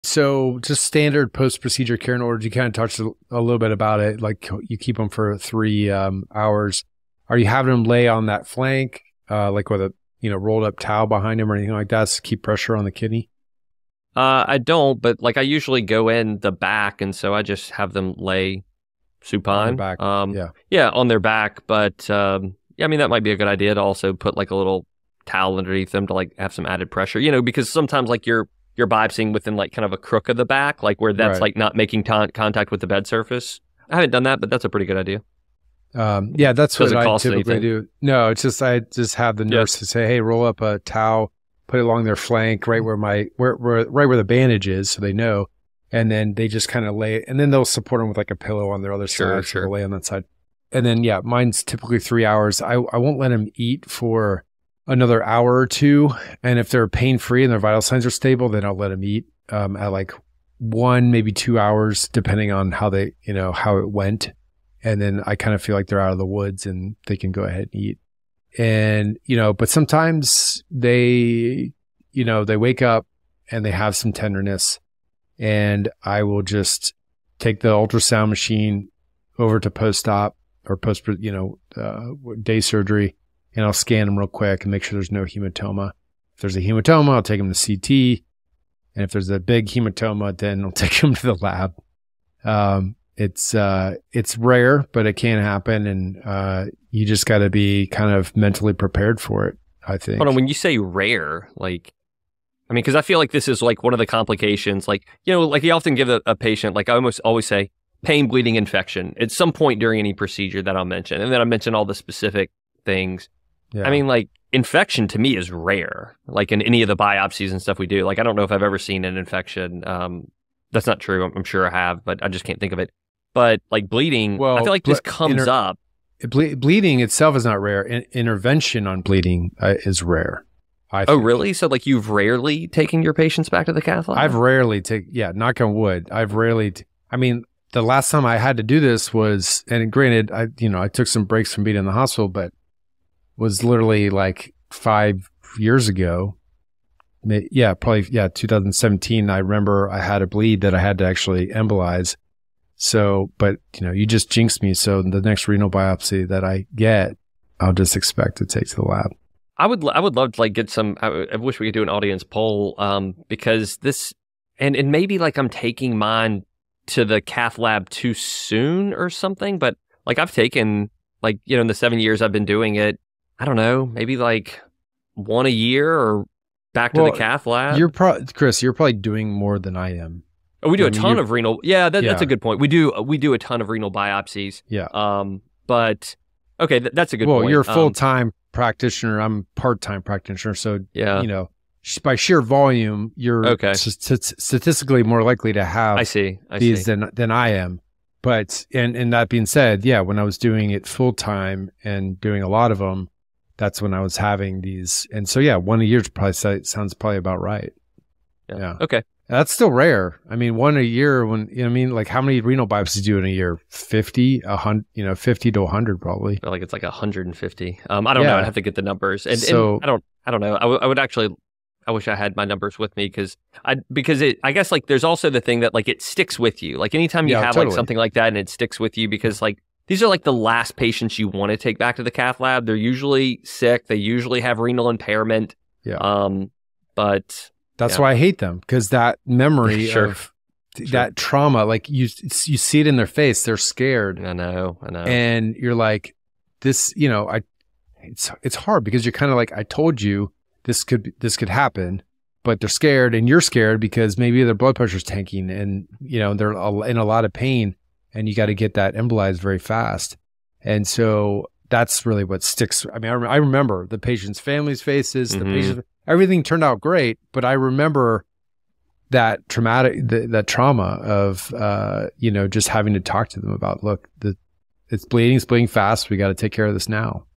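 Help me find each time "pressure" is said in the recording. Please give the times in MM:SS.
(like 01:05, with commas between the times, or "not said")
00:12, 00:26, 04:14.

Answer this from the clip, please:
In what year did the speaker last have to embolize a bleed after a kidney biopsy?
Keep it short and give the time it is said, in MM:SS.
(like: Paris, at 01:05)
2017, at 02:28.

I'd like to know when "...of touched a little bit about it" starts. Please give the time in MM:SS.
00:02.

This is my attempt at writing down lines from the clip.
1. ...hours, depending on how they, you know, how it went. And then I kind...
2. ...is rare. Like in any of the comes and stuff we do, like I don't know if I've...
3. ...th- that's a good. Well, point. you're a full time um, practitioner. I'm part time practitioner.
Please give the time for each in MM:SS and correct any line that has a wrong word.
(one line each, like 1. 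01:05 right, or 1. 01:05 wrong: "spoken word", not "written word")
1. 01:01 right
2. 01:55 wrong: "biopsies", not "comes"
3. 03:06 right.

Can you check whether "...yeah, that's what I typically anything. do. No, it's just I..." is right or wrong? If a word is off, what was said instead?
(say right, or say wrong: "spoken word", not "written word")
right.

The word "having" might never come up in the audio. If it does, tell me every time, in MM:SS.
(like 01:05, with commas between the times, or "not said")
00:07, 03:24, 04:32.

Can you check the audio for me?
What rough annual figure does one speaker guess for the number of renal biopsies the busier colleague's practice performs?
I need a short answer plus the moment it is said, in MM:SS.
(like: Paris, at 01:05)
150, at 03:36.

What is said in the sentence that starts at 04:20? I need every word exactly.
And so that's really what sticks.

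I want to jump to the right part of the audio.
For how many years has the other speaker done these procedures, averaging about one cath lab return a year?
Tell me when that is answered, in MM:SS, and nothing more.
02:51.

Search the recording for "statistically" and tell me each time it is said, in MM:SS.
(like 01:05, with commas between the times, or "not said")
03:14.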